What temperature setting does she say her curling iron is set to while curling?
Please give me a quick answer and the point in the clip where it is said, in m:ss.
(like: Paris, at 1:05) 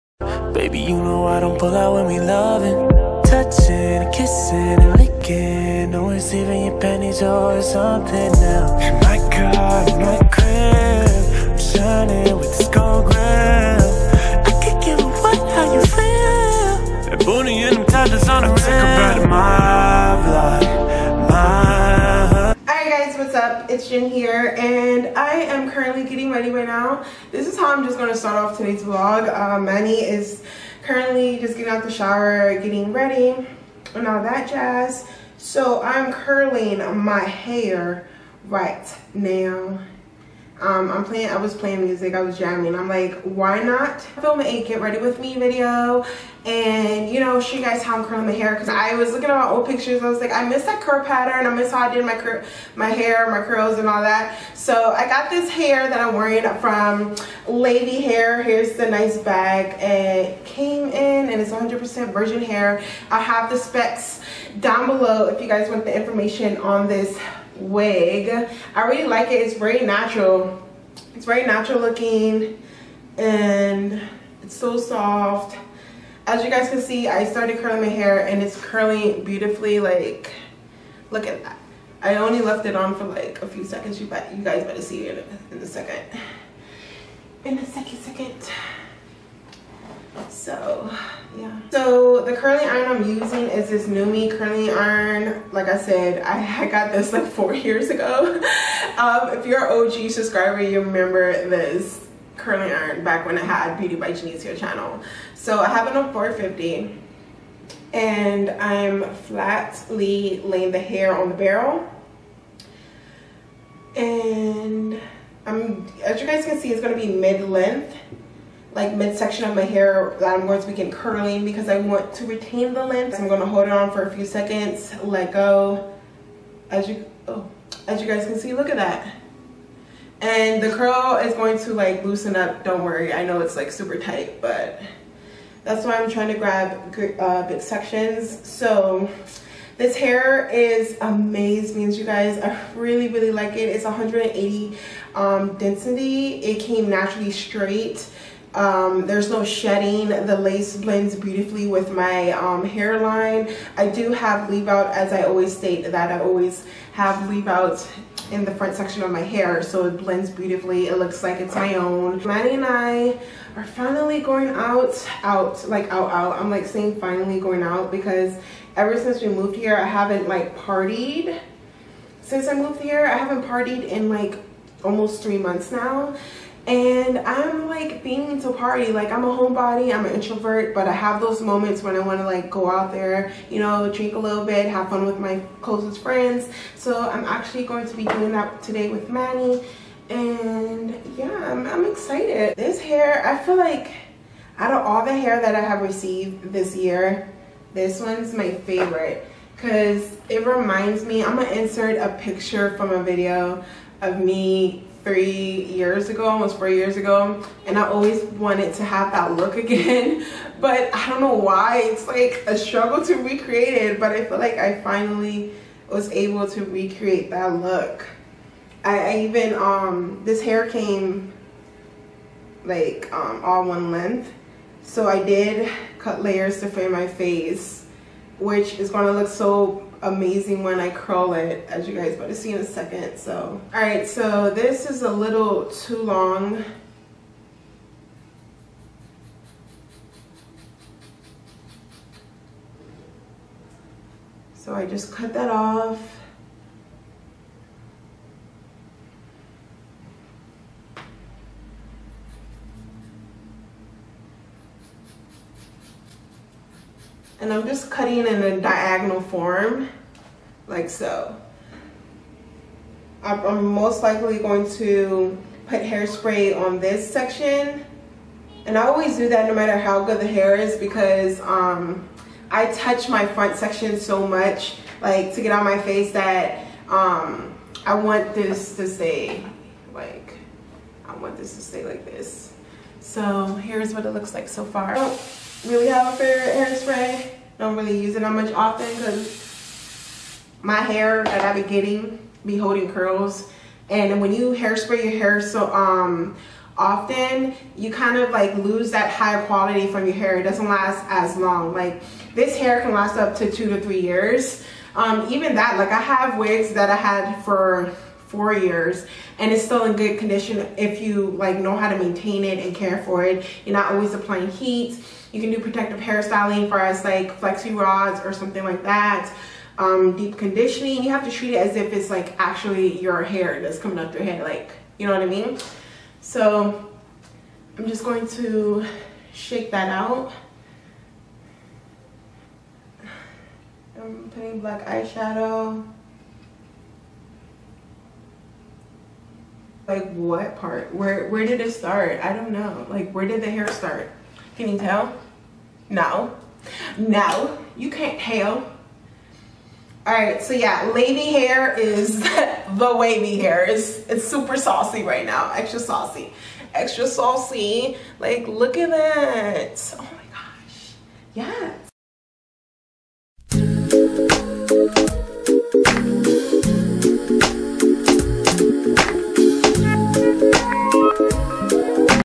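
450, at 1:46.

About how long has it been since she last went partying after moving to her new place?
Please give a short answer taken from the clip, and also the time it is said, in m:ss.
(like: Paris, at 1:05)
almost three months, at 2:54.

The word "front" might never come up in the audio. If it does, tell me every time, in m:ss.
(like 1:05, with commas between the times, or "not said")
2:38, 4:33.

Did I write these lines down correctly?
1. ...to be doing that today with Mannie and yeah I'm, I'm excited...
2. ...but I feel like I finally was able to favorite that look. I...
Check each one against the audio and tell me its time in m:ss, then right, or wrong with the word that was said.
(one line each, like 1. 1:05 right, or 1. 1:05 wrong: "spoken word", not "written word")
1. 3:07 right
2. 3:33 wrong: "recreate", not "favorite".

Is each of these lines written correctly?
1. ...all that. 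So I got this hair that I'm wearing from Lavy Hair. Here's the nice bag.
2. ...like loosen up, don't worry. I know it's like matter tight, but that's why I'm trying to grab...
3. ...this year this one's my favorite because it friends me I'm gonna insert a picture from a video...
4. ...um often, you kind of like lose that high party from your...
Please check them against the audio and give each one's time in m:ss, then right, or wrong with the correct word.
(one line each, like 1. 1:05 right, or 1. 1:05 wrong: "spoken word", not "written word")
1. 0:53 right
2. 2:11 wrong: "super", not "matter"
3. 3:16 wrong: "reminds", not "friends"
4. 4:55 wrong: "quality", not "party".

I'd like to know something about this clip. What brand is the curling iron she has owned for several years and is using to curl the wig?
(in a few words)
NuMe.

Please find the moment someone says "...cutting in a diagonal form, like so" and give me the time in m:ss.
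4:17.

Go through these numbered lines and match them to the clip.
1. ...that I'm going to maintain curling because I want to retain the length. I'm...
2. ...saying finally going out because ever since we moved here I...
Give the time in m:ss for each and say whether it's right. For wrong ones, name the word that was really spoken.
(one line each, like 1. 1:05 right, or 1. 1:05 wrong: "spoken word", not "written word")
1. 2:00 wrong: "begin", not "maintain"
2. 2:46 right.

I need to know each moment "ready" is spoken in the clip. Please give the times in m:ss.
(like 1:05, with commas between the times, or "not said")
0:26, 0:32, 0:44.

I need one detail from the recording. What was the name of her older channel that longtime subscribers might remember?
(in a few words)
Beauty by Genecia.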